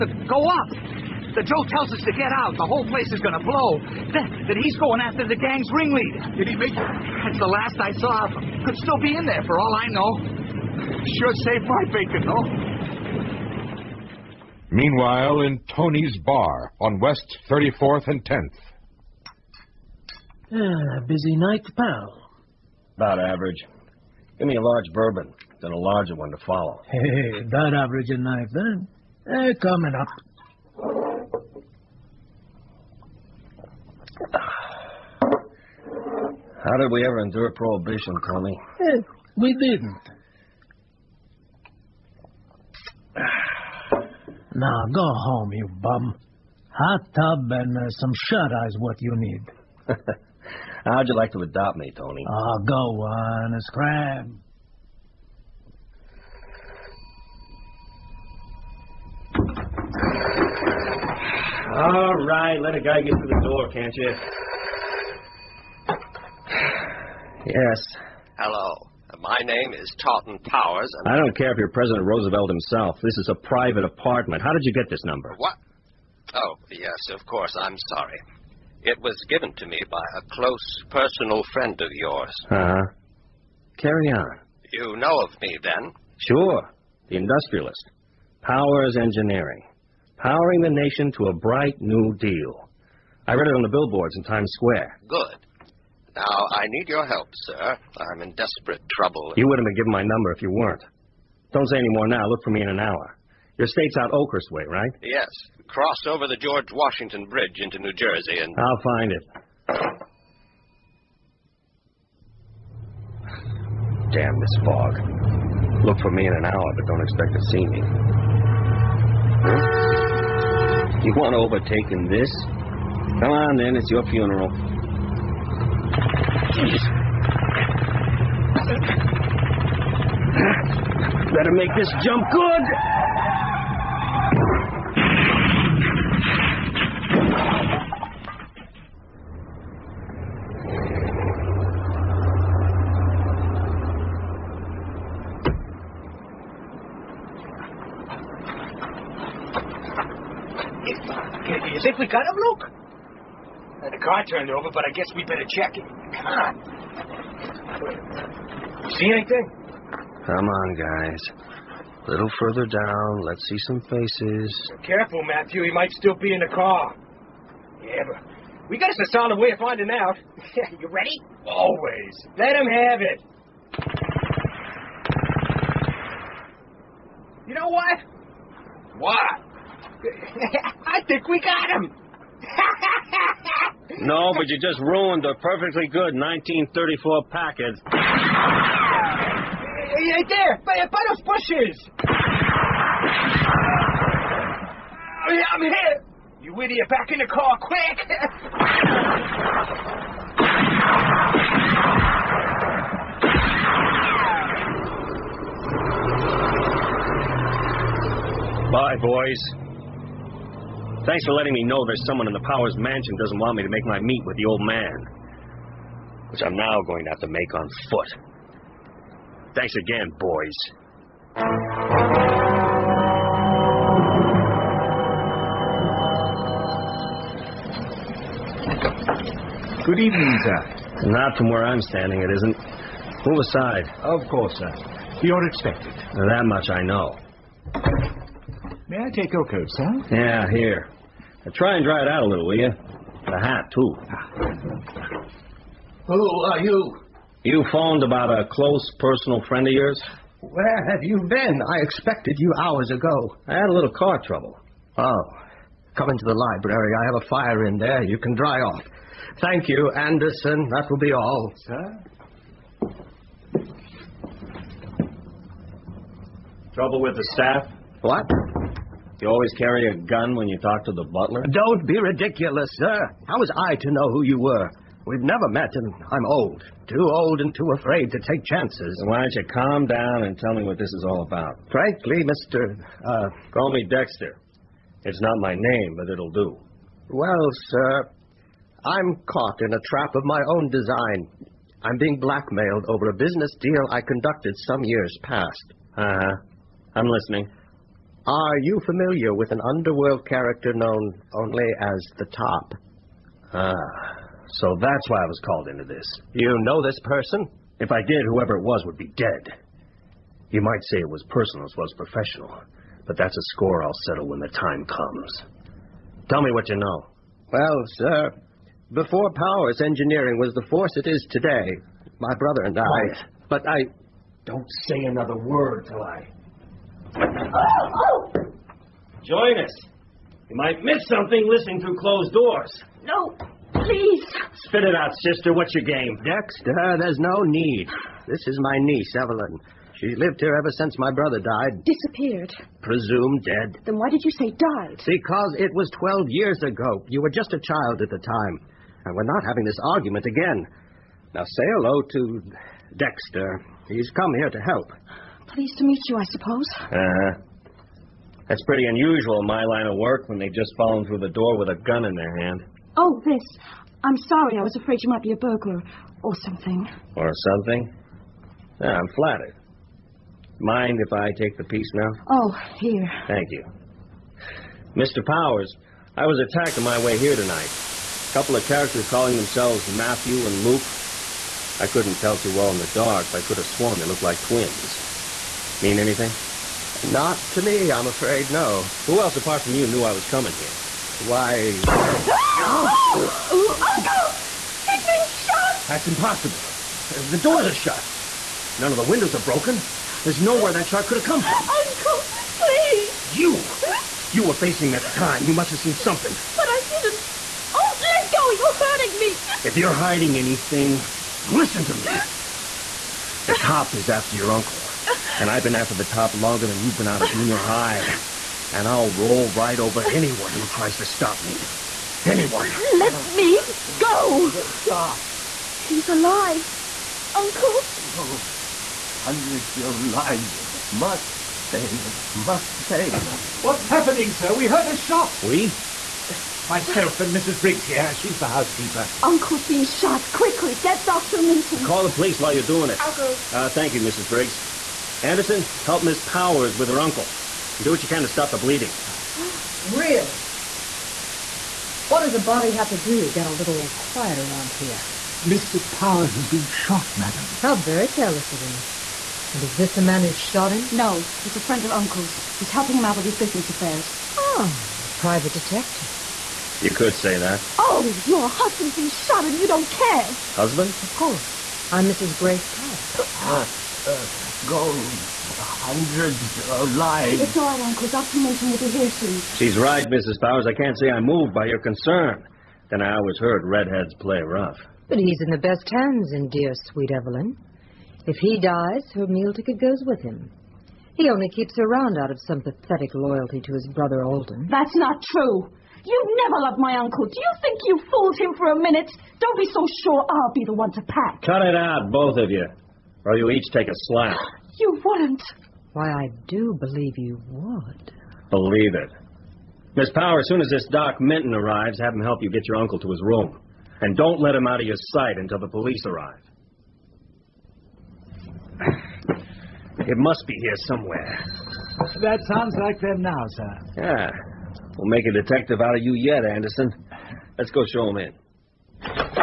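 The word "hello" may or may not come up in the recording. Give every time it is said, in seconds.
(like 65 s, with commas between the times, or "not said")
68 s, 351 s.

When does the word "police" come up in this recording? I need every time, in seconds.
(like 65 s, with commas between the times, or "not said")
442 s, 515 s.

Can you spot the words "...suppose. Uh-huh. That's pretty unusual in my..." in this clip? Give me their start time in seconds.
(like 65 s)
356 s.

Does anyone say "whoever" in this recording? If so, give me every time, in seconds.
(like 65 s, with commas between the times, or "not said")
308 s.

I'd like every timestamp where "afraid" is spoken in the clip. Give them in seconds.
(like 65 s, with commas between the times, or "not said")
277 s, 364 s, 388 s.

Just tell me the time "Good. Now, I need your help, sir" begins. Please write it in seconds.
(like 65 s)
95 s.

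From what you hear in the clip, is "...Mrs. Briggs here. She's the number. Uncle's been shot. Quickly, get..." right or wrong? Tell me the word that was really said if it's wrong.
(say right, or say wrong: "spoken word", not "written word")
wrong: "housekeeper", not "number".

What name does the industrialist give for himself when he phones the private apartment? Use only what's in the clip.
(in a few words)
Tarleton Powers.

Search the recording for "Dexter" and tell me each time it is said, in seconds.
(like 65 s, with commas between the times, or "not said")
283 s, 336 s, 352 s.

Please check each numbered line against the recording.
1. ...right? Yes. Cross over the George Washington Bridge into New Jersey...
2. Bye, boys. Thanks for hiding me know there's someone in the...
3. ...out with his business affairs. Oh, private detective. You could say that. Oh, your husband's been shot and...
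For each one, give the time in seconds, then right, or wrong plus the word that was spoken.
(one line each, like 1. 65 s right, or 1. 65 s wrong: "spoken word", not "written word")
1. 104 s right
2. 208 s wrong: "letting", not "hiding"
3. 463 s right.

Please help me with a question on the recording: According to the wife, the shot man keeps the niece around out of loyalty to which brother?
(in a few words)
Alden.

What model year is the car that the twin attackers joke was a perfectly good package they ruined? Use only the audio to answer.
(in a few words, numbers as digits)
1934.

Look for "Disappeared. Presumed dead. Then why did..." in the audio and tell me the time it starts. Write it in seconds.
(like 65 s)
341 s.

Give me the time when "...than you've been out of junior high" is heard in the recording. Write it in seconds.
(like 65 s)
416 s.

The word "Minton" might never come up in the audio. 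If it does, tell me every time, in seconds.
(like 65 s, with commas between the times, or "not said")
441 s, 478 s, 511 s.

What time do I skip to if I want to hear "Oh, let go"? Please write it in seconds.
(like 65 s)
407 s.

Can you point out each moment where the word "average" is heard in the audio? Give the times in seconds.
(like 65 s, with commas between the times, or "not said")
23 s, 27 s.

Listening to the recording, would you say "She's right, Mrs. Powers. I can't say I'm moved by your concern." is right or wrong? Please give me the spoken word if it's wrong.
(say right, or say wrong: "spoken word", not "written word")
right.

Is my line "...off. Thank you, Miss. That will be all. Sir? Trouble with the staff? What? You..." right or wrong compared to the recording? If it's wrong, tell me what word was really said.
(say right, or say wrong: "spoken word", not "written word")
wrong: "Anderson", not "Miss".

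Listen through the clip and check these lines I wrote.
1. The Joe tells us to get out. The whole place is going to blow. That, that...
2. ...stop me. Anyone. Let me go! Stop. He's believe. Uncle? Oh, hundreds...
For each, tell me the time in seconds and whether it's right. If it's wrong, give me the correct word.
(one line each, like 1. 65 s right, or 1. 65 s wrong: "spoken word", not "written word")
1. 1 s right
2. 421 s wrong: "alive", not "believe".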